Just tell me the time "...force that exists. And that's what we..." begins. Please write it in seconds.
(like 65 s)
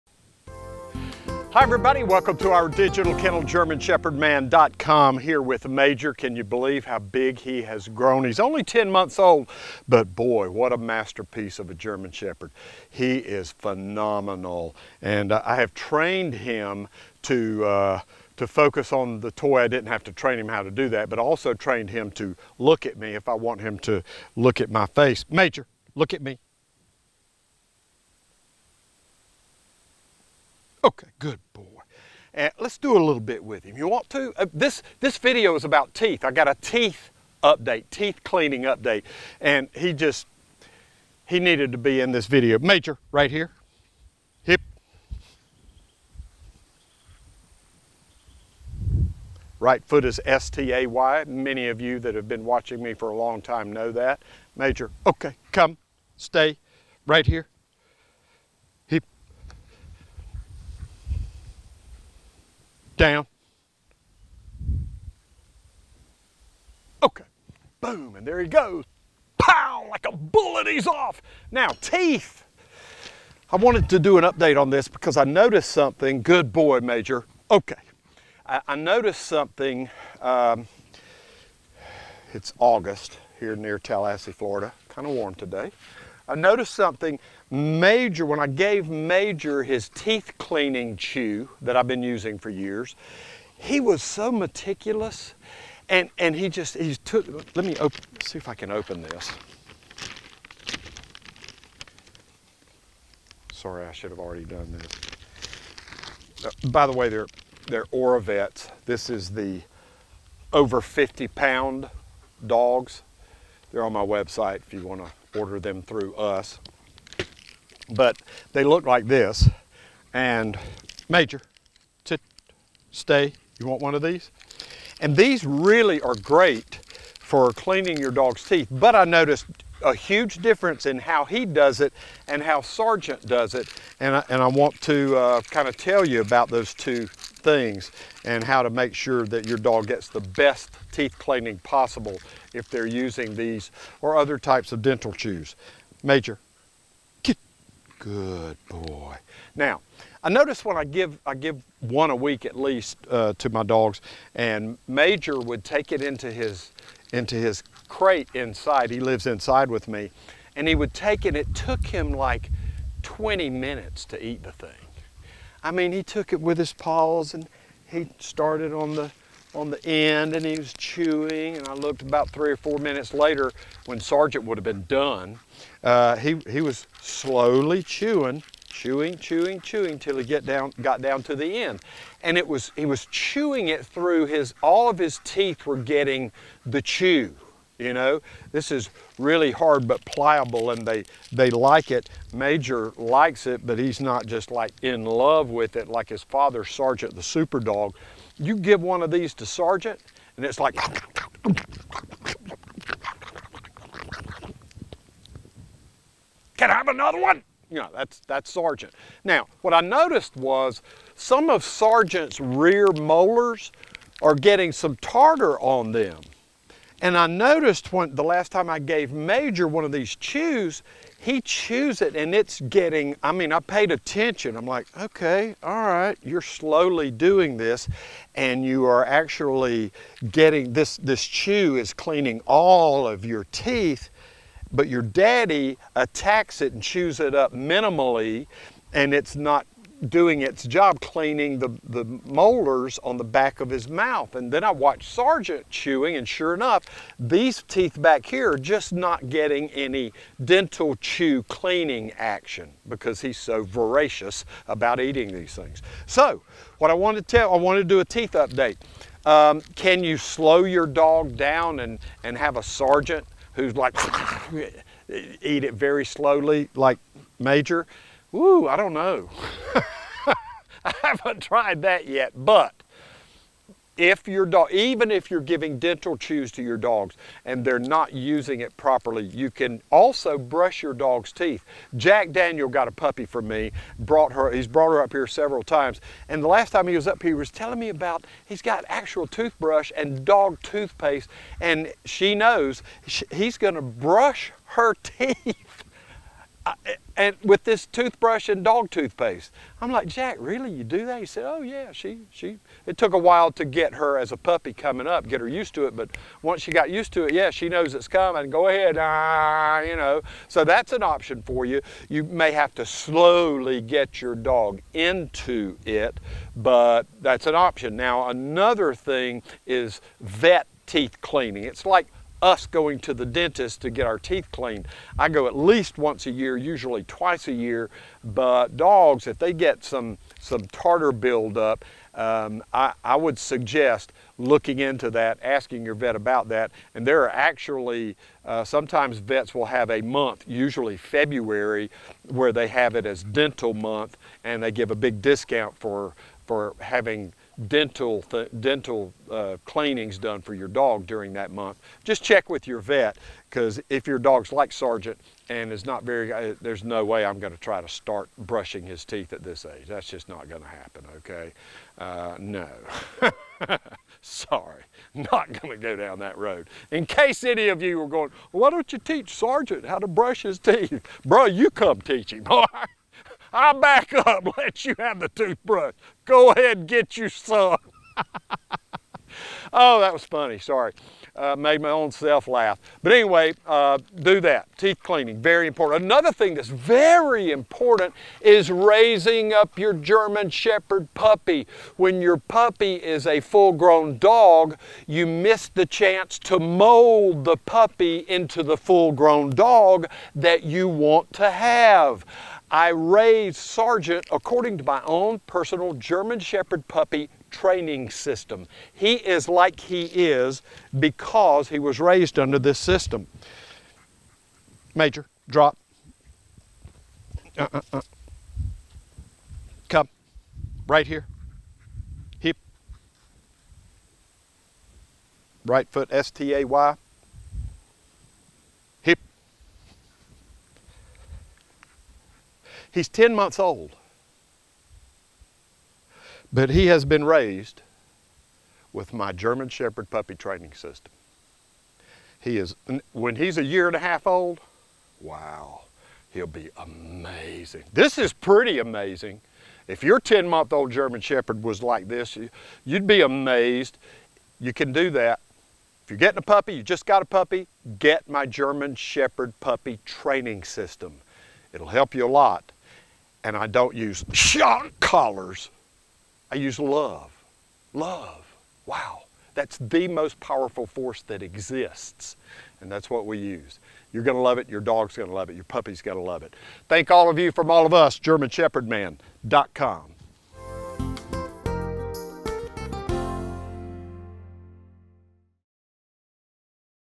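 470 s.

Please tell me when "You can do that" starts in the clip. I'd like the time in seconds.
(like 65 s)
454 s.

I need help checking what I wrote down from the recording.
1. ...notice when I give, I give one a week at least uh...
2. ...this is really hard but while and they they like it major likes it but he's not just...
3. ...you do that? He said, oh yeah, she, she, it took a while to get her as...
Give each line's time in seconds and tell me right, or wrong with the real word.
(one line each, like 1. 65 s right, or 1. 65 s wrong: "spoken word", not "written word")
1. 150 s right
2. 188 s wrong: "pliable", not "while"
3. 300 s right.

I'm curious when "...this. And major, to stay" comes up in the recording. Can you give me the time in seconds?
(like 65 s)
119 s.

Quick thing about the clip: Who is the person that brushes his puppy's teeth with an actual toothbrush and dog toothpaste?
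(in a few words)
Jack Daniel.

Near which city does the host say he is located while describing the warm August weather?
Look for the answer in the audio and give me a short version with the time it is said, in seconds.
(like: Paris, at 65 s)
Tallahassee, Florida, at 83 s.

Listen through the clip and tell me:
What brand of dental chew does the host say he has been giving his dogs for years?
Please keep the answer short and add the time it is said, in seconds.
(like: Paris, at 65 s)
OraVets, at 107 s.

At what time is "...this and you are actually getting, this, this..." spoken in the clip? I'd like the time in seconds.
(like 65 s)
227 s.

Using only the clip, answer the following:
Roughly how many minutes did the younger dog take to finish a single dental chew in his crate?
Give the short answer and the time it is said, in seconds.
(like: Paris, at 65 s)
20 minutes, at 163 s.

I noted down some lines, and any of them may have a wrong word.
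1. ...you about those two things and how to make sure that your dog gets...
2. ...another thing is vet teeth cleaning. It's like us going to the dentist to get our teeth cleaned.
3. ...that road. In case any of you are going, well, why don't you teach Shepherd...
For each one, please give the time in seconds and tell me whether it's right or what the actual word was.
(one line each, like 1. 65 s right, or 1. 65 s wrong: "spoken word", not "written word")
1. 136 s right
2. 318 s right
3. 366 s wrong: "Sergeant", not "Shepherd".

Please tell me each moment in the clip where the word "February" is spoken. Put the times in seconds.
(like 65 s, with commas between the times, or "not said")
340 s.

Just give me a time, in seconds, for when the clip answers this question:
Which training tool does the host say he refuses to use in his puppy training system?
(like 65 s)
464 s.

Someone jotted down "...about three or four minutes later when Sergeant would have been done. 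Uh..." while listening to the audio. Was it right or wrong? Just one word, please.
right.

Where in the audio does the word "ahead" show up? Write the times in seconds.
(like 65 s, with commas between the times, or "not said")
308 s, 376 s.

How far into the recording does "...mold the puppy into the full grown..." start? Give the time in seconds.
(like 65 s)
396 s.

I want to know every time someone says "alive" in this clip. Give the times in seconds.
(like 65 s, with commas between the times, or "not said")
not said.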